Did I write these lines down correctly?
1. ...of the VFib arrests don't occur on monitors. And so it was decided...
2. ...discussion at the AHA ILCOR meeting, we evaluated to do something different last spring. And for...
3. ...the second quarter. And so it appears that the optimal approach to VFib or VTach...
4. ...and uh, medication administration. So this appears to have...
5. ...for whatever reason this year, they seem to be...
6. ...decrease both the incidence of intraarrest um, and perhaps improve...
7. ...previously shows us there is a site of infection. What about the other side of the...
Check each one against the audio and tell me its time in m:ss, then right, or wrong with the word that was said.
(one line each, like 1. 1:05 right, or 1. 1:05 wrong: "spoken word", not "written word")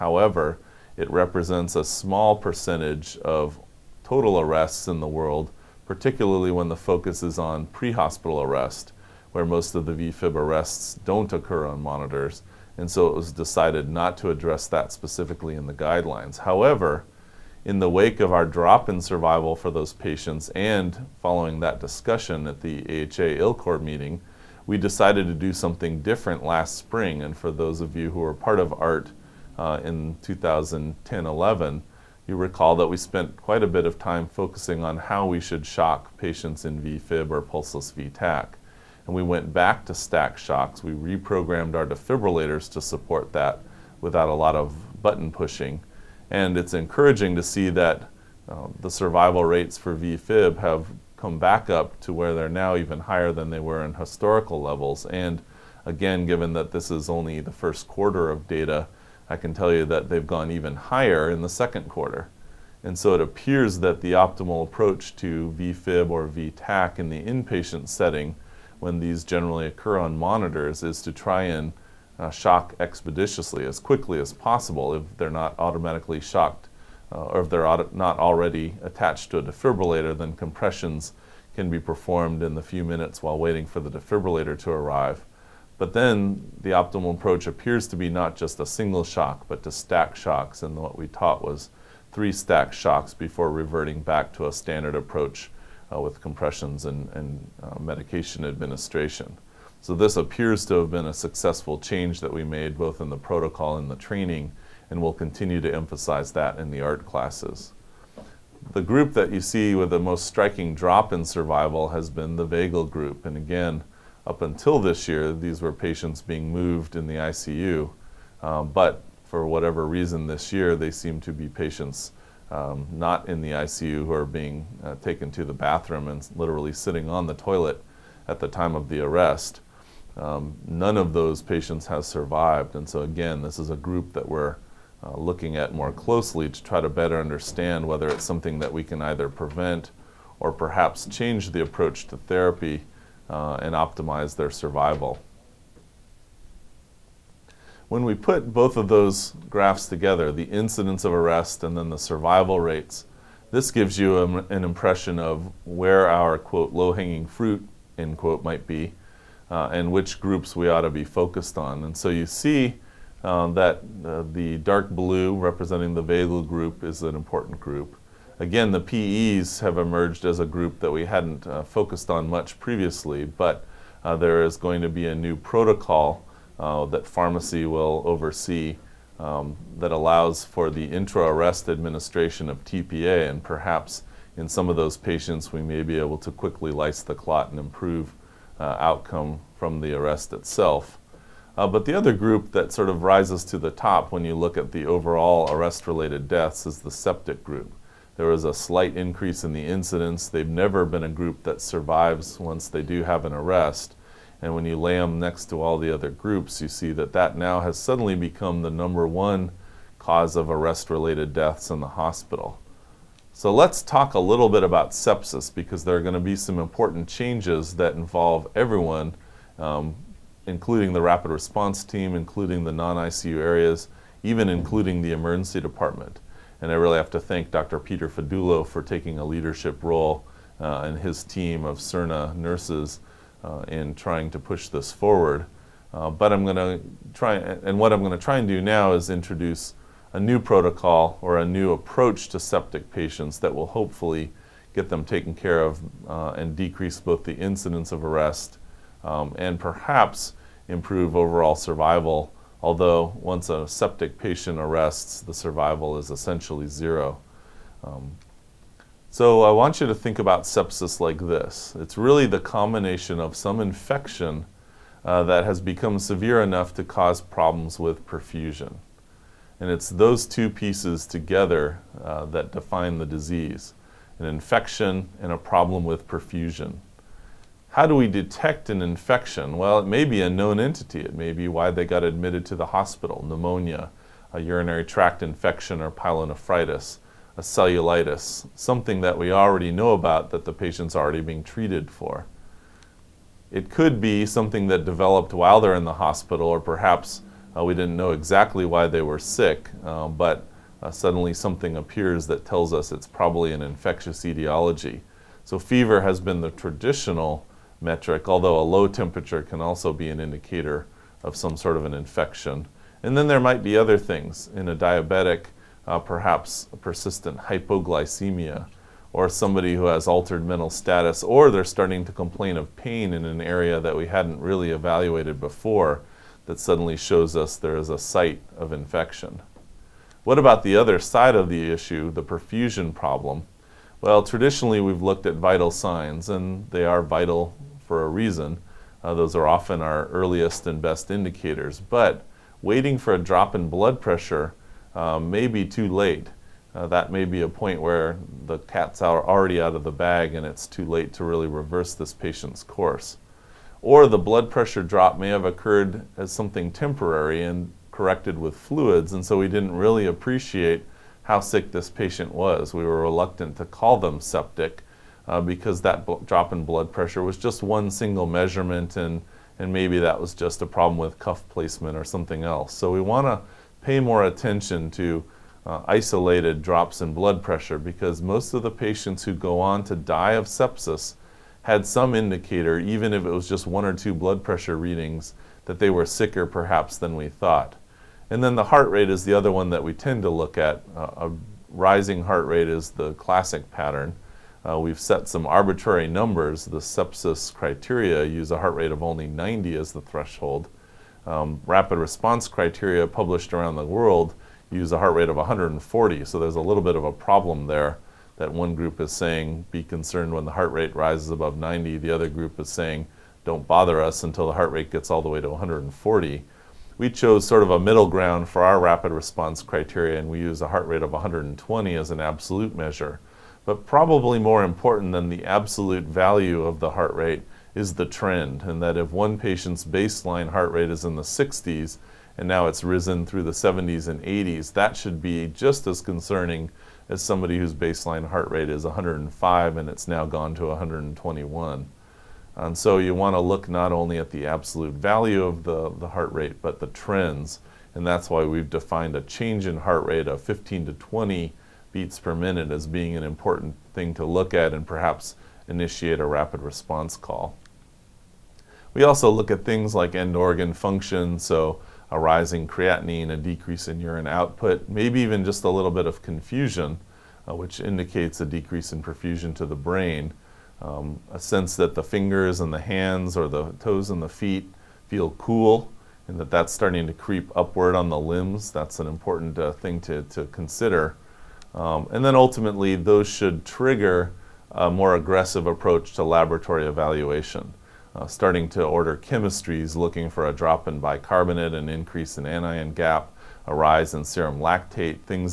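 1. 0:09 right
2. 0:21 wrong: "decided", not "evaluated"
3. 1:01 right
4. 1:37 right
5. 1:59 right
6. 4:06 wrong: "arrest", not "intraarrest"
7. 5:26 wrong: "suddenly", not "previously".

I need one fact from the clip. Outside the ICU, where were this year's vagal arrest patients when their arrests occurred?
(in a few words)
On the toilet.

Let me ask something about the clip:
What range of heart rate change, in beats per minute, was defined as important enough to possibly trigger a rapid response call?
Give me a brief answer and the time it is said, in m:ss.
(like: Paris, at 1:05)
15 to 20, at 7:30.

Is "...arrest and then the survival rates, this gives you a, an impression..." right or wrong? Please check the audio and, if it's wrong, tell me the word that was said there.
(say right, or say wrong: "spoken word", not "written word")
right.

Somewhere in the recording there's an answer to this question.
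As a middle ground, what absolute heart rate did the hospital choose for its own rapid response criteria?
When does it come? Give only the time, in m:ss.
7:01.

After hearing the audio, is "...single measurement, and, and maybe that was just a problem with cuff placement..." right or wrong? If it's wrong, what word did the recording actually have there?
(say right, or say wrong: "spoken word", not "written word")
right.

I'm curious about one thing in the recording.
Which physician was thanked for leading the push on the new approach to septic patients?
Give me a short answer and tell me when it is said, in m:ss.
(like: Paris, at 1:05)
Dr. Peter Fedullo, at 3:47.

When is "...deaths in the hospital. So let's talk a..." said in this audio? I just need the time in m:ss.
3:31.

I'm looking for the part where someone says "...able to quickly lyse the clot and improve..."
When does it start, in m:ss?
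3:05.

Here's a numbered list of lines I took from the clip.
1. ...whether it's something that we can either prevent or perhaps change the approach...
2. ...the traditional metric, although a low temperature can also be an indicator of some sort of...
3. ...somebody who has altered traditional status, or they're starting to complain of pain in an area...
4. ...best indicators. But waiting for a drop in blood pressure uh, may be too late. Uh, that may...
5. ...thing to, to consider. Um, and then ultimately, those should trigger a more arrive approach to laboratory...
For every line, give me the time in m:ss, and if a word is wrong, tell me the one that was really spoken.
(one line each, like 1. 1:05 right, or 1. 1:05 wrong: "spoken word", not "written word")
1. 2:17 right
2. 5:06 right
3. 5:19 wrong: "mental", not "traditional"
4. 5:40 right
5. 7:59 wrong: "aggressive", not "arrive".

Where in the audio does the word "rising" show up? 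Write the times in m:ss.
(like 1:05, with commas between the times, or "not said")
6:31, 7:42.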